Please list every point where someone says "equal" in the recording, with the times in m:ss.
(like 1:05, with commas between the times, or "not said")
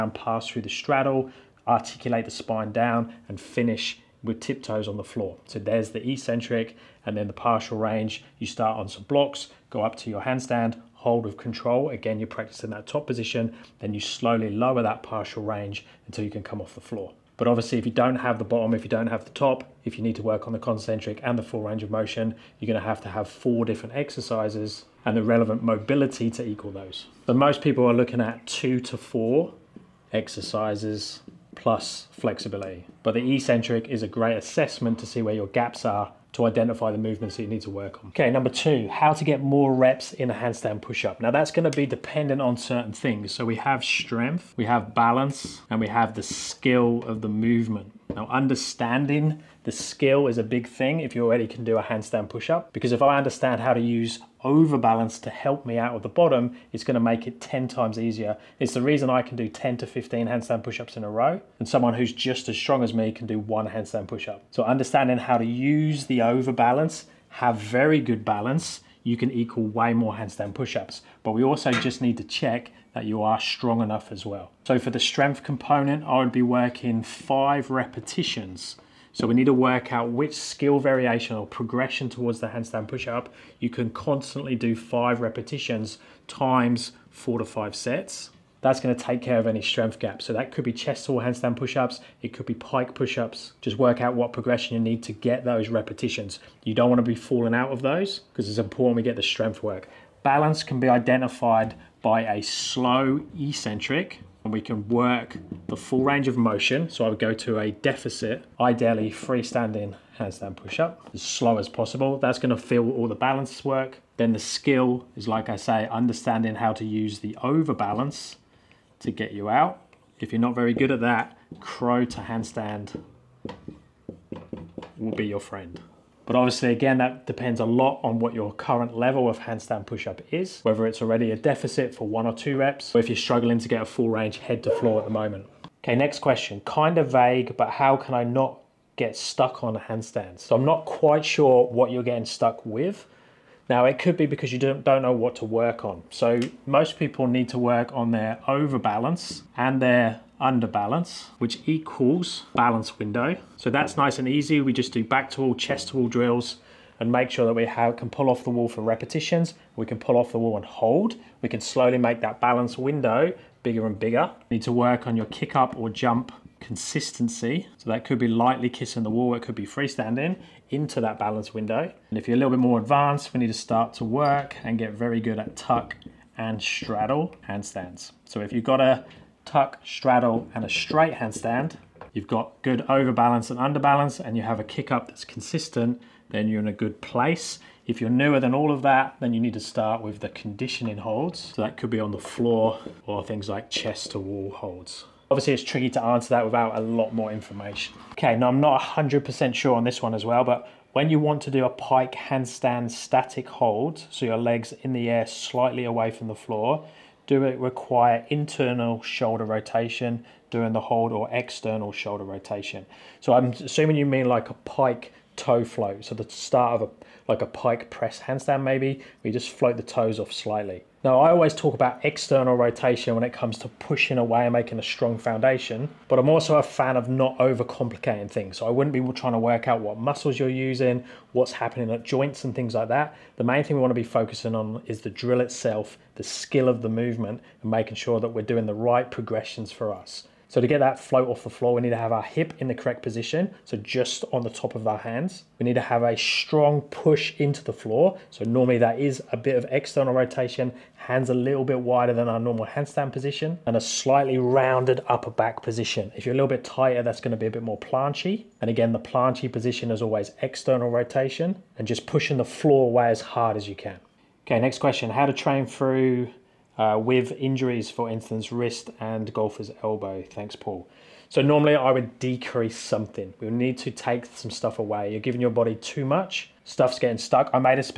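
0:26, 1:09, 2:31.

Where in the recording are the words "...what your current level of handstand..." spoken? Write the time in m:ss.
2:08.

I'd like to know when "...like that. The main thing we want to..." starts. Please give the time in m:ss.
3:52.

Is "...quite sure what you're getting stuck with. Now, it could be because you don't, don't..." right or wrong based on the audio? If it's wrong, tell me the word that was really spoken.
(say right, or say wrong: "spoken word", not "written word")
right.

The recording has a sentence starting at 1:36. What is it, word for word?
You don't wanna be falling out of those because it's important we get the strength work.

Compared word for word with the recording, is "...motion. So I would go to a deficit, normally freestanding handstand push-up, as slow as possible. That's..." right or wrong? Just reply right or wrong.
wrong.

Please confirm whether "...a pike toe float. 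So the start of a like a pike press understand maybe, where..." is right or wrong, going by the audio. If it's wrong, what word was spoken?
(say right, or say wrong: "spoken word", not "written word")
wrong: "handstand", not "understand".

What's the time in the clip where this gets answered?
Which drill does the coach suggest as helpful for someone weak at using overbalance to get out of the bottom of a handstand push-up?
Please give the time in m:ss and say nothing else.
2:01.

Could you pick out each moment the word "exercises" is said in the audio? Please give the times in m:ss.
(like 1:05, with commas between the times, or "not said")
0:23, 0:30.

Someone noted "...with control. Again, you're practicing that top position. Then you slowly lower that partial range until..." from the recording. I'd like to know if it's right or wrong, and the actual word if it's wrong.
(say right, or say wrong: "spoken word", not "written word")
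right.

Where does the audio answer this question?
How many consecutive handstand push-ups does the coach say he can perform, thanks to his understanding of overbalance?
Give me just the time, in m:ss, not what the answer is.
0:59.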